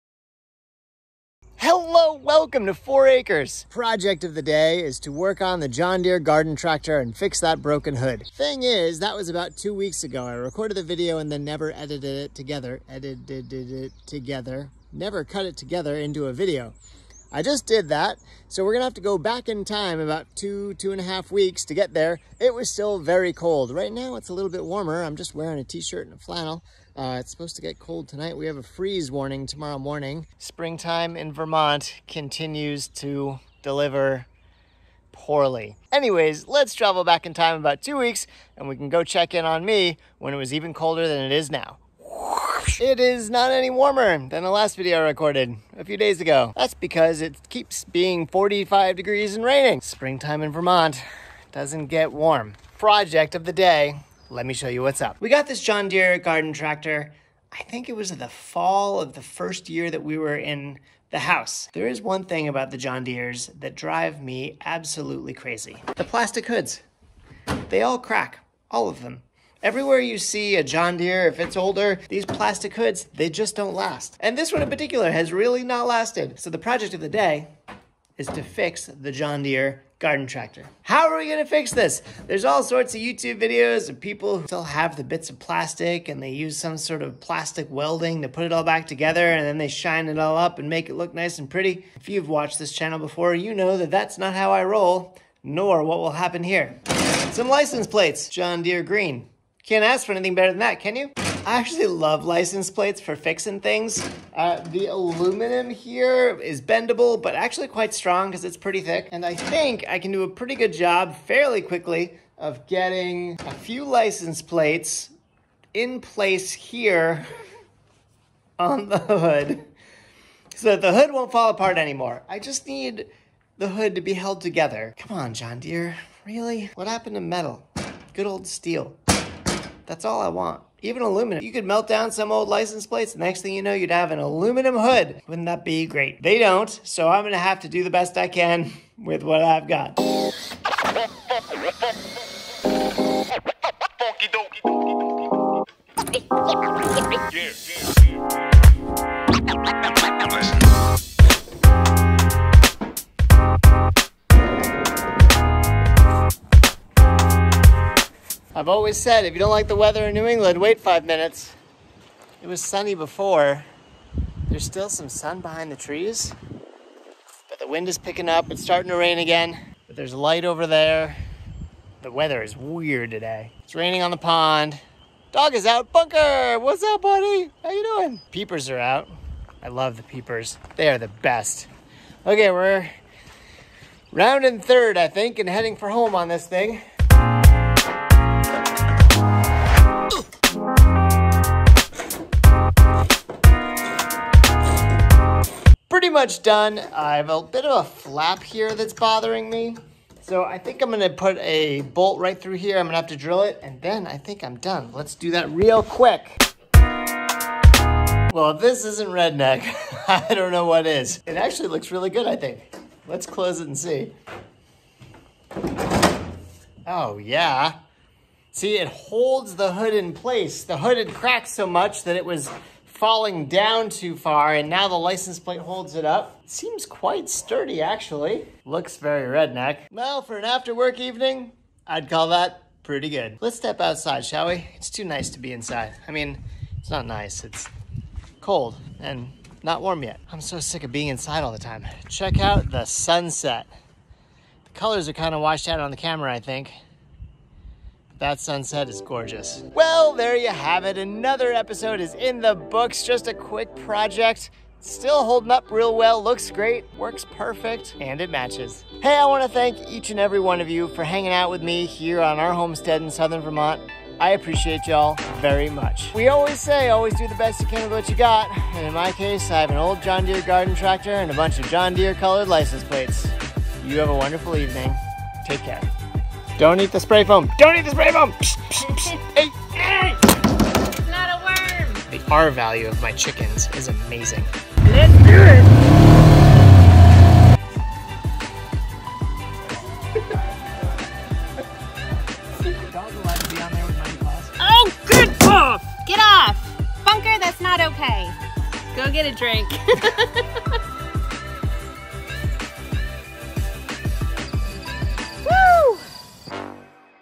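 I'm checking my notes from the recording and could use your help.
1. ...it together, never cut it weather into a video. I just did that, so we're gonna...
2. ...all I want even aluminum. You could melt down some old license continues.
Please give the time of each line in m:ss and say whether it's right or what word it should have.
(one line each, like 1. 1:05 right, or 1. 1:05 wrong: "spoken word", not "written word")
1. 0:13 wrong: "together", not "weather"
2. 2:10 wrong: "plates", not "continues".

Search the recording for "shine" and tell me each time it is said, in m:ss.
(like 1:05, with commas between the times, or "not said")
1:29.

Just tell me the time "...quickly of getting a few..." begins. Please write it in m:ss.
1:51.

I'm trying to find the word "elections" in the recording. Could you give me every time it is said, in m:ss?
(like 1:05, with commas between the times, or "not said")
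not said.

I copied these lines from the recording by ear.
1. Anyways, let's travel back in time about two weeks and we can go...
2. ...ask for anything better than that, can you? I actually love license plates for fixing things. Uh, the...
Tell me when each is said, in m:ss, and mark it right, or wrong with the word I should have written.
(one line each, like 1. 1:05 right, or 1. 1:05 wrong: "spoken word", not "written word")
1. 0:35 right
2. 1:39 right.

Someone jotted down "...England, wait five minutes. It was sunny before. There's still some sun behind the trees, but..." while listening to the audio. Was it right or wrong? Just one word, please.
right.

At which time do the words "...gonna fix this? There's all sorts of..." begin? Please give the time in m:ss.
1:21.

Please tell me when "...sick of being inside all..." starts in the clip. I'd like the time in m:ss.
4:00.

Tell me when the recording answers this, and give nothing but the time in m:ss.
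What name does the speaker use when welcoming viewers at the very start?
0:02.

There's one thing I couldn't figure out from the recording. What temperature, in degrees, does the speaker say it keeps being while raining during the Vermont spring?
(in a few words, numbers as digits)
45.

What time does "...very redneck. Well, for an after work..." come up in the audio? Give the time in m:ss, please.
3:48.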